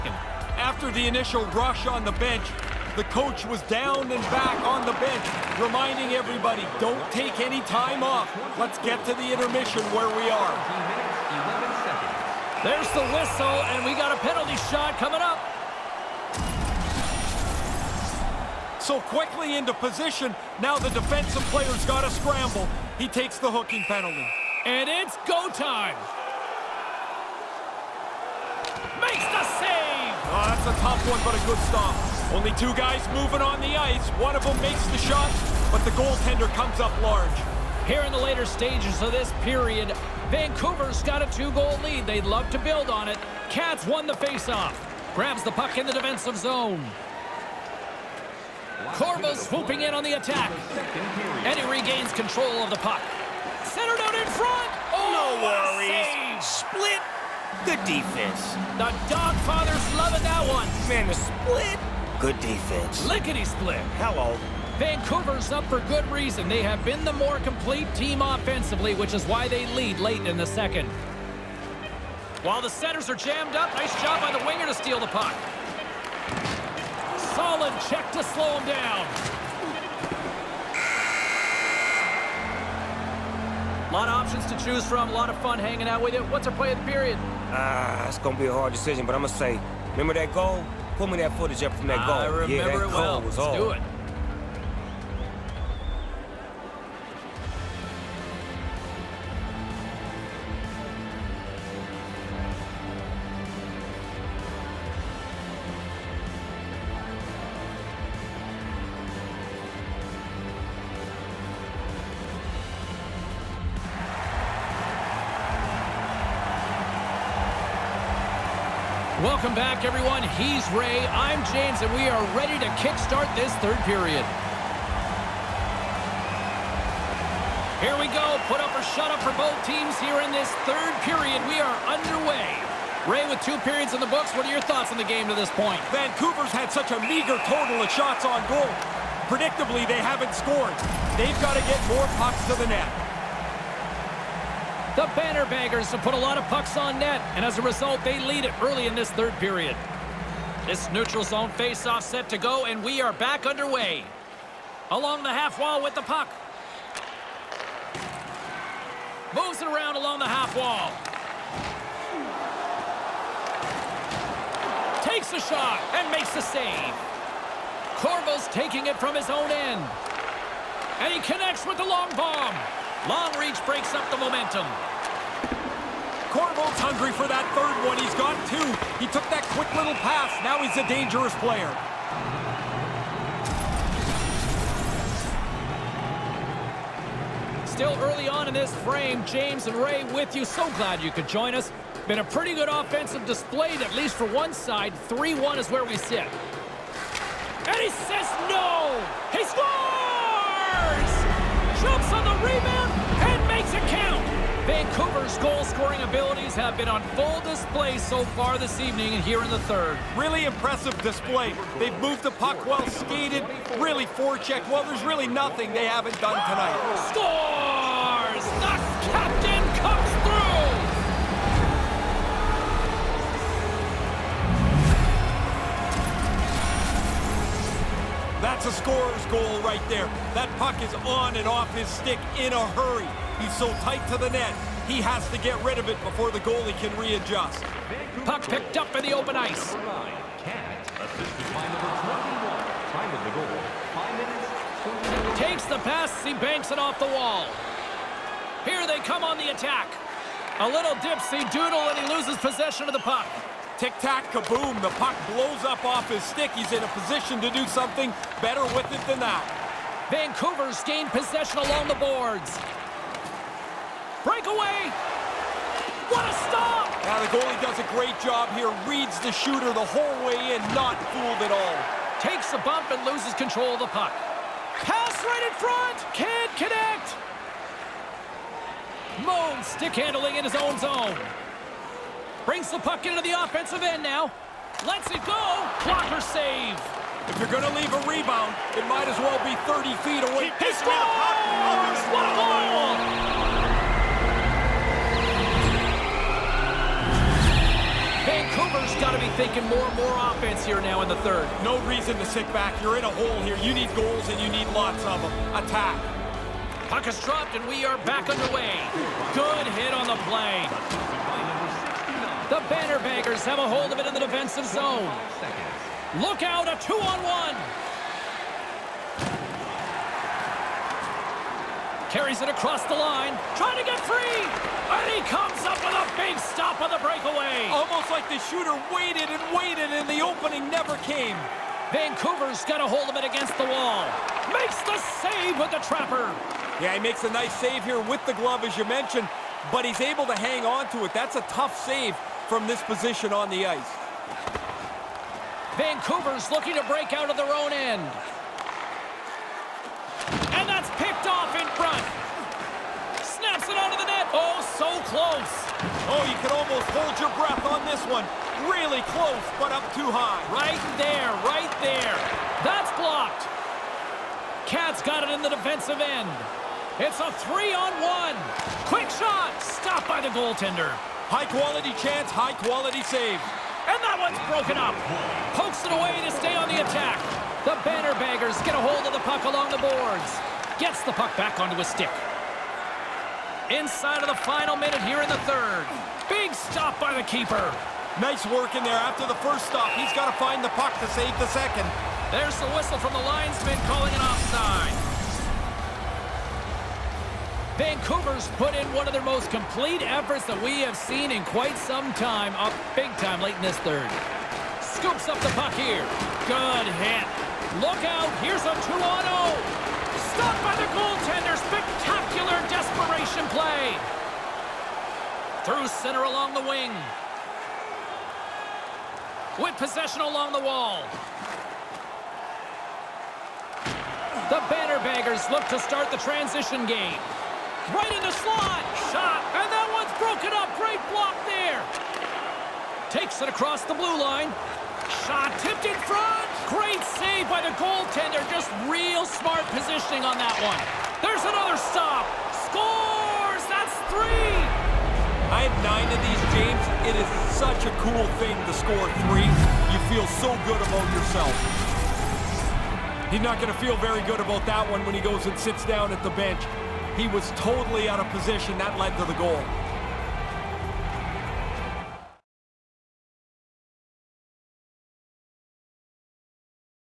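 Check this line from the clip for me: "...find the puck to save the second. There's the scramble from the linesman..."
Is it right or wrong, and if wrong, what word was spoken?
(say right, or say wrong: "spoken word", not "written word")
wrong: "whistle", not "scramble".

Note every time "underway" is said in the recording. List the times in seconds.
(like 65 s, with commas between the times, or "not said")
131 s, 153 s, 308 s.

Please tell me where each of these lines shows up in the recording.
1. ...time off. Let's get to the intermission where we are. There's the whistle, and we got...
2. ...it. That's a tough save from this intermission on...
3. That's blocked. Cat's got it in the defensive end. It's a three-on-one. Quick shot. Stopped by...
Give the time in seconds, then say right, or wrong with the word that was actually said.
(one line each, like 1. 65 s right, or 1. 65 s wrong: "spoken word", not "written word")
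1. 7 s right
2. 341 s wrong: "position", not "intermission"
3. 362 s right.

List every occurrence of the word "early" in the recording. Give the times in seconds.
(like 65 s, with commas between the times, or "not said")
148 s, 188 s.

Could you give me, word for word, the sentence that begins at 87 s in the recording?
Ah, uh, it's going to be a hard decision, but I'm going to say, remember that goal?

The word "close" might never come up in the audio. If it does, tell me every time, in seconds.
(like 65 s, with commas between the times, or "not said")
355 s, 359 s.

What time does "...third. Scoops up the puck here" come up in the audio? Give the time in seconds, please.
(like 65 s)
403 s.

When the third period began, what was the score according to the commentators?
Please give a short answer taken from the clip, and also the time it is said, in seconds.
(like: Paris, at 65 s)
3-1, at 195 s.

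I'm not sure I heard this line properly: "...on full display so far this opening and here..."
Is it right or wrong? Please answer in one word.
wrong.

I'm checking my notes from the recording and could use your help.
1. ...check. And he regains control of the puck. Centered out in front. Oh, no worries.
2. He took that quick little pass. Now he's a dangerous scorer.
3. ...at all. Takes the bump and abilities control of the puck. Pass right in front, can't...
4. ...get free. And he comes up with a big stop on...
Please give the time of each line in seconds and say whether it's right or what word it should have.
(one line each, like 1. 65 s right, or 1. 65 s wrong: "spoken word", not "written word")
1. 50 s wrong: "attack", not "check"
2. 179 s wrong: "player", not "scorer"
3. 271 s wrong: "loses", not "abilities"
4. 323 s right.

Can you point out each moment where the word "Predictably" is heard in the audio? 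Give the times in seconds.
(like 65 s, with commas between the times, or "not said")
139 s.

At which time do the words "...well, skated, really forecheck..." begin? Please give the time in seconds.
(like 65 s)
212 s.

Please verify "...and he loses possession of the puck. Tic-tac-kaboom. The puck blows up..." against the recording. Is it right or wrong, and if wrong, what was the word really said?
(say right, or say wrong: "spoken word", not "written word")
right.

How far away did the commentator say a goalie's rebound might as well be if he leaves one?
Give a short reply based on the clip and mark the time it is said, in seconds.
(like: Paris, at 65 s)
30 feet, at 289 s.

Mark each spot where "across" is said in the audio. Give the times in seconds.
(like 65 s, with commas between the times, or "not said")
322 s, 433 s.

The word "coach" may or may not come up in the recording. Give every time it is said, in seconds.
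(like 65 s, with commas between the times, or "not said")
3 s.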